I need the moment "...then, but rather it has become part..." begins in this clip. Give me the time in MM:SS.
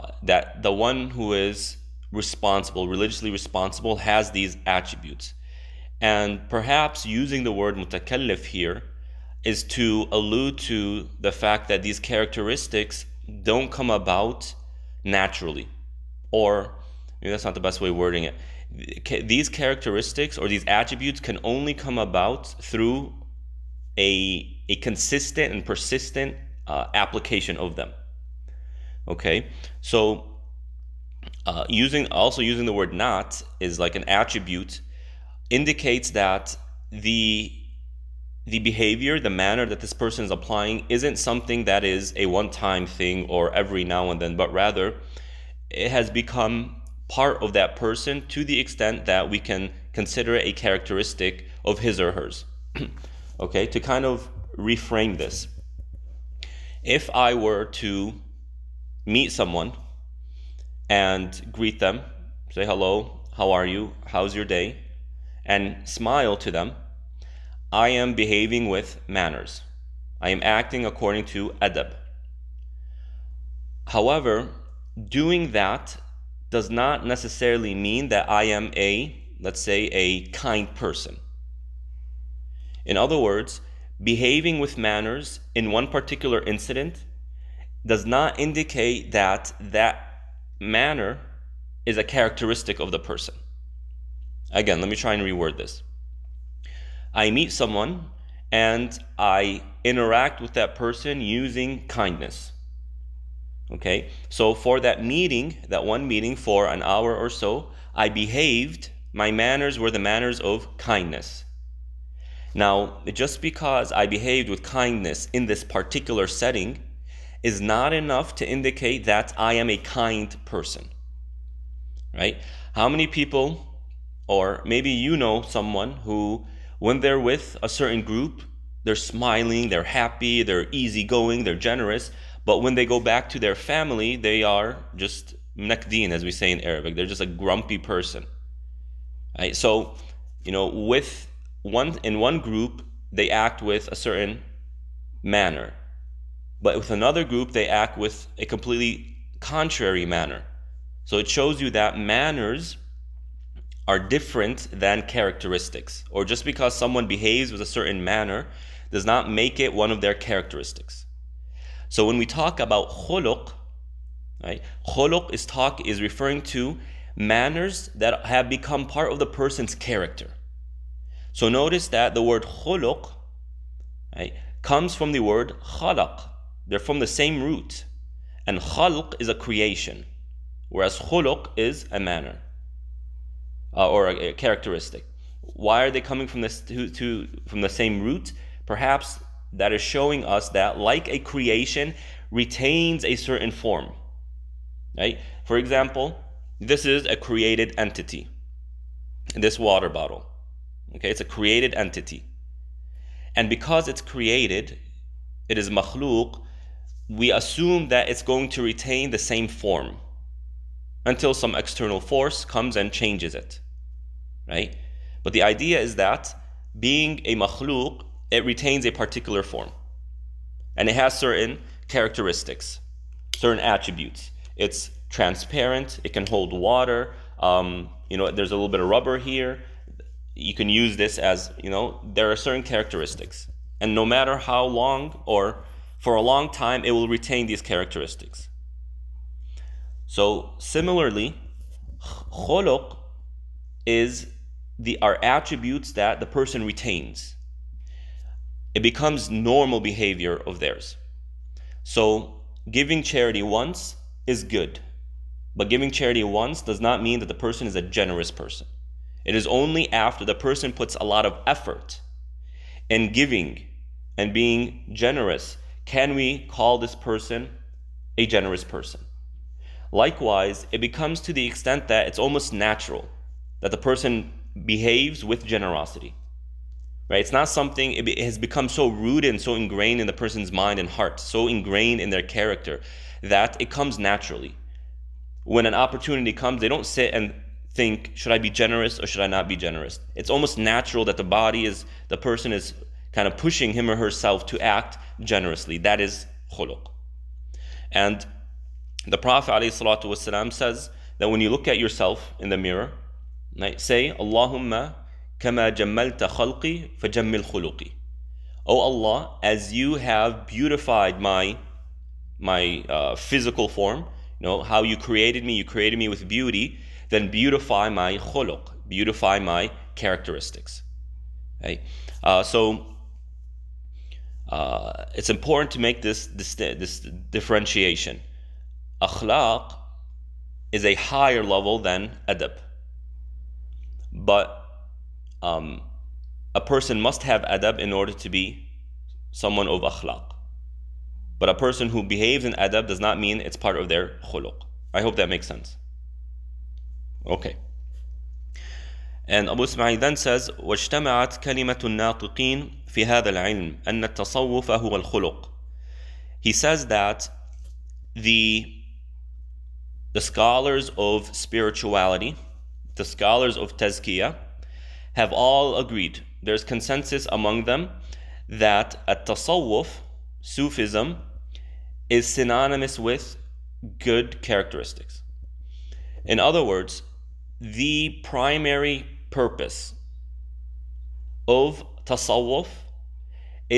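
00:44.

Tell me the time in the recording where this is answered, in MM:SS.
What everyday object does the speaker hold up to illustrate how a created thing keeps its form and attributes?
03:19.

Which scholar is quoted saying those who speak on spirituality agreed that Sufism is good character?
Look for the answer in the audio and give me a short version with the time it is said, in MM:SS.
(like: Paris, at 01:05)
Abu Ismail, at 05:49.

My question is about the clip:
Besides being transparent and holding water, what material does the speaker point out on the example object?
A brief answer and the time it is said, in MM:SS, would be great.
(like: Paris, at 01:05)
rubber, at 03:48.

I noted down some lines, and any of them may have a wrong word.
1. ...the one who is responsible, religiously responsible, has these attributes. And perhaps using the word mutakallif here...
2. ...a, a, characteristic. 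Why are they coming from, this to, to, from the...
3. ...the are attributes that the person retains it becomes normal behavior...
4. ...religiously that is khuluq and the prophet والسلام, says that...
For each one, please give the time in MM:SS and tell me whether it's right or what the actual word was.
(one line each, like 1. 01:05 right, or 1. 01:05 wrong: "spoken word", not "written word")
1. 00:00 right
2. 03:04 right
3. 04:04 right
4. 04:55 wrong: "generously", not "religiously".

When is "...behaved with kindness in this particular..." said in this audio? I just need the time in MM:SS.
01:54.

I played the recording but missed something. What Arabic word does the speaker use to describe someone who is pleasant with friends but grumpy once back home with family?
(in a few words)
nakdeen.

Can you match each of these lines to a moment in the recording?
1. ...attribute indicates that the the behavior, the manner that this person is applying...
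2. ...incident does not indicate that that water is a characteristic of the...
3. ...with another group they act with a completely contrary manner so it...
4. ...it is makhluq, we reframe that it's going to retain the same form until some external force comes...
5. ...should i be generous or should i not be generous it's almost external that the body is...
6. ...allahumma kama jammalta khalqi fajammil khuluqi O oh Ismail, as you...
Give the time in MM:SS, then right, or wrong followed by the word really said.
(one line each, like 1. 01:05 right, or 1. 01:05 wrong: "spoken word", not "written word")
1. 00:34 right
2. 01:26 wrong: "manner", not "water"
3. 02:26 right
4. 03:25 wrong: "assume", not "reframe"
5. 04:48 wrong: "natural", not "external"
6. 05:04 wrong: "Allah", not "Ismail".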